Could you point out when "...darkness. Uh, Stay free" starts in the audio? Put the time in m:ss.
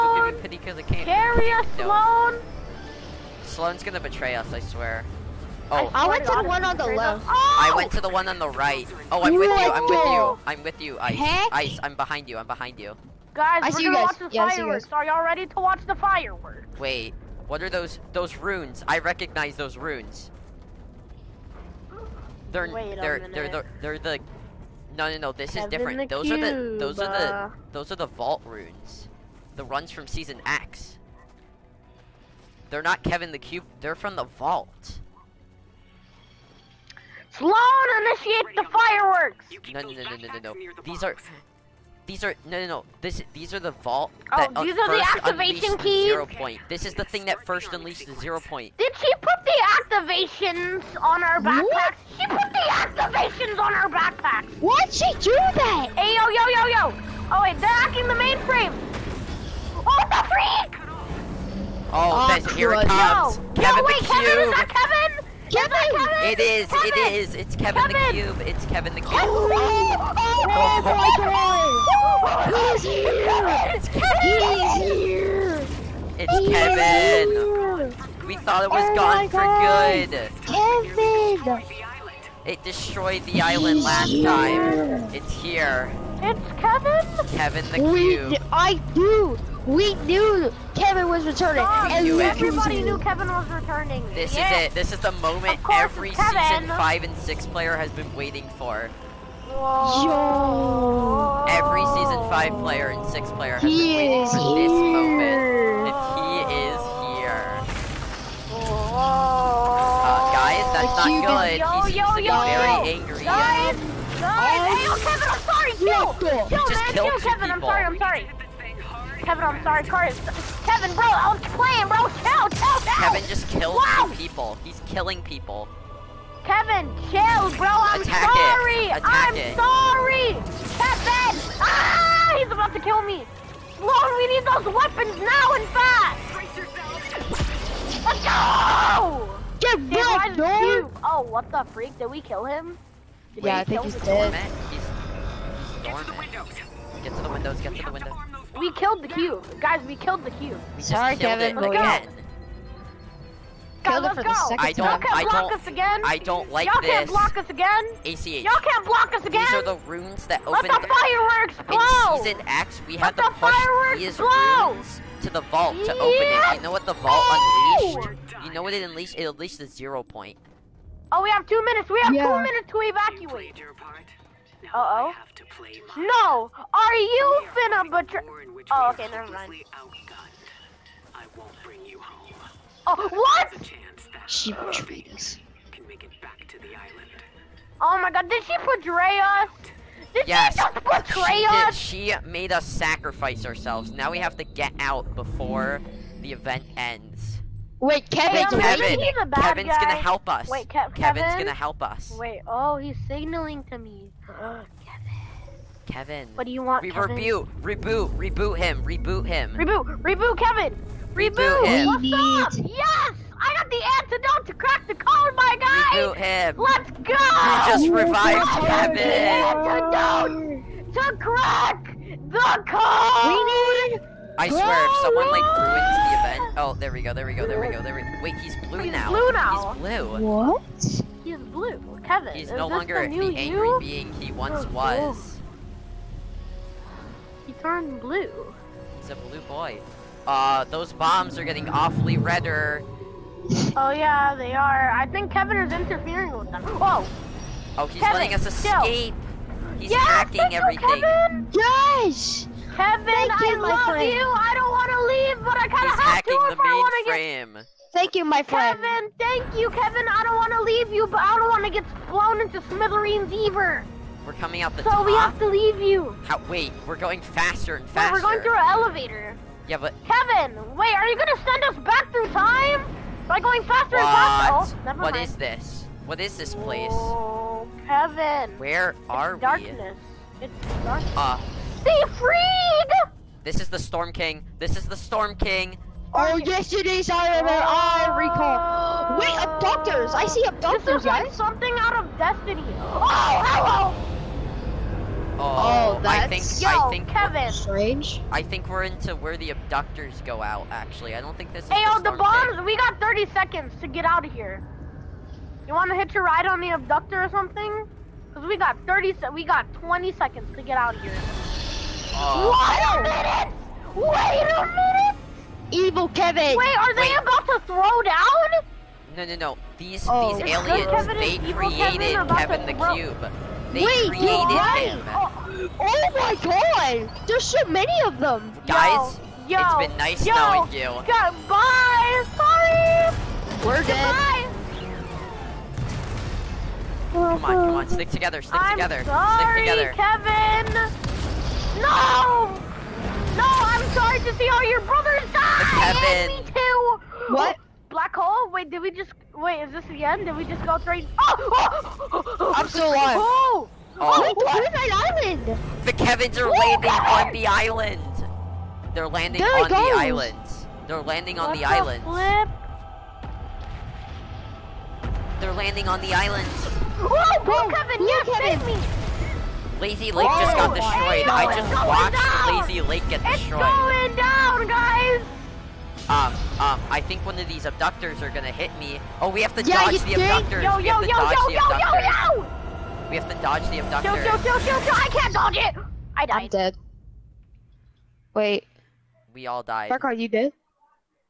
4:40.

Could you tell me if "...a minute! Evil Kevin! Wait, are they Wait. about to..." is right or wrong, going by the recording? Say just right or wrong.
right.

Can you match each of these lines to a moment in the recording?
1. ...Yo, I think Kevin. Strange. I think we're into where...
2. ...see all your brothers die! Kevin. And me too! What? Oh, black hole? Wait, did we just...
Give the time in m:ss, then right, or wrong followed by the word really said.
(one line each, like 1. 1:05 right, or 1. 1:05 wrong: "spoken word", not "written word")
1. 4:56 right
2. 5:44 right.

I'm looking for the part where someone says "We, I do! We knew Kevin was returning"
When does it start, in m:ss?
1:28.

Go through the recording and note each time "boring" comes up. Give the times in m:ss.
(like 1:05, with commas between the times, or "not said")
not said.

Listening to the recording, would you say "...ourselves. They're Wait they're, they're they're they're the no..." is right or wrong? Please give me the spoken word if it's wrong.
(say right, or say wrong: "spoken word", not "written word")
wrong: "runes", not "ourselves".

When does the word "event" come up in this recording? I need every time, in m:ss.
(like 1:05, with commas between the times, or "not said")
3:16, 3:46.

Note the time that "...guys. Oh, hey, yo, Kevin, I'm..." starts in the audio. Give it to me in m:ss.
1:53.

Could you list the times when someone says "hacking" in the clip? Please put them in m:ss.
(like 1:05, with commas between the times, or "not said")
0:57, 4:09.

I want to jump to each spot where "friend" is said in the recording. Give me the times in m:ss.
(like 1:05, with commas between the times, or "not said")
4:13, 4:18.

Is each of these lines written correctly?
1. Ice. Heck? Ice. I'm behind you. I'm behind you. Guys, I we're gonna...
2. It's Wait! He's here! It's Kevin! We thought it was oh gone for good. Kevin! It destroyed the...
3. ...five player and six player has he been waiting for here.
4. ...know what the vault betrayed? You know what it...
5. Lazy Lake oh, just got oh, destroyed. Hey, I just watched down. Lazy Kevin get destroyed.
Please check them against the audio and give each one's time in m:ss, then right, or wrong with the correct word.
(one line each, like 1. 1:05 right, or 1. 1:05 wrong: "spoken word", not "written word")
1. 0:10 right
2. 1:13 wrong: "Kevin", not "Wait"
3. 1:42 right
4. 2:46 wrong: "unleashed", not "betrayed"
5. 6:09 wrong: "Lake", not "Kevin".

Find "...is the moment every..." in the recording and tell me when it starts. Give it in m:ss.
1:34.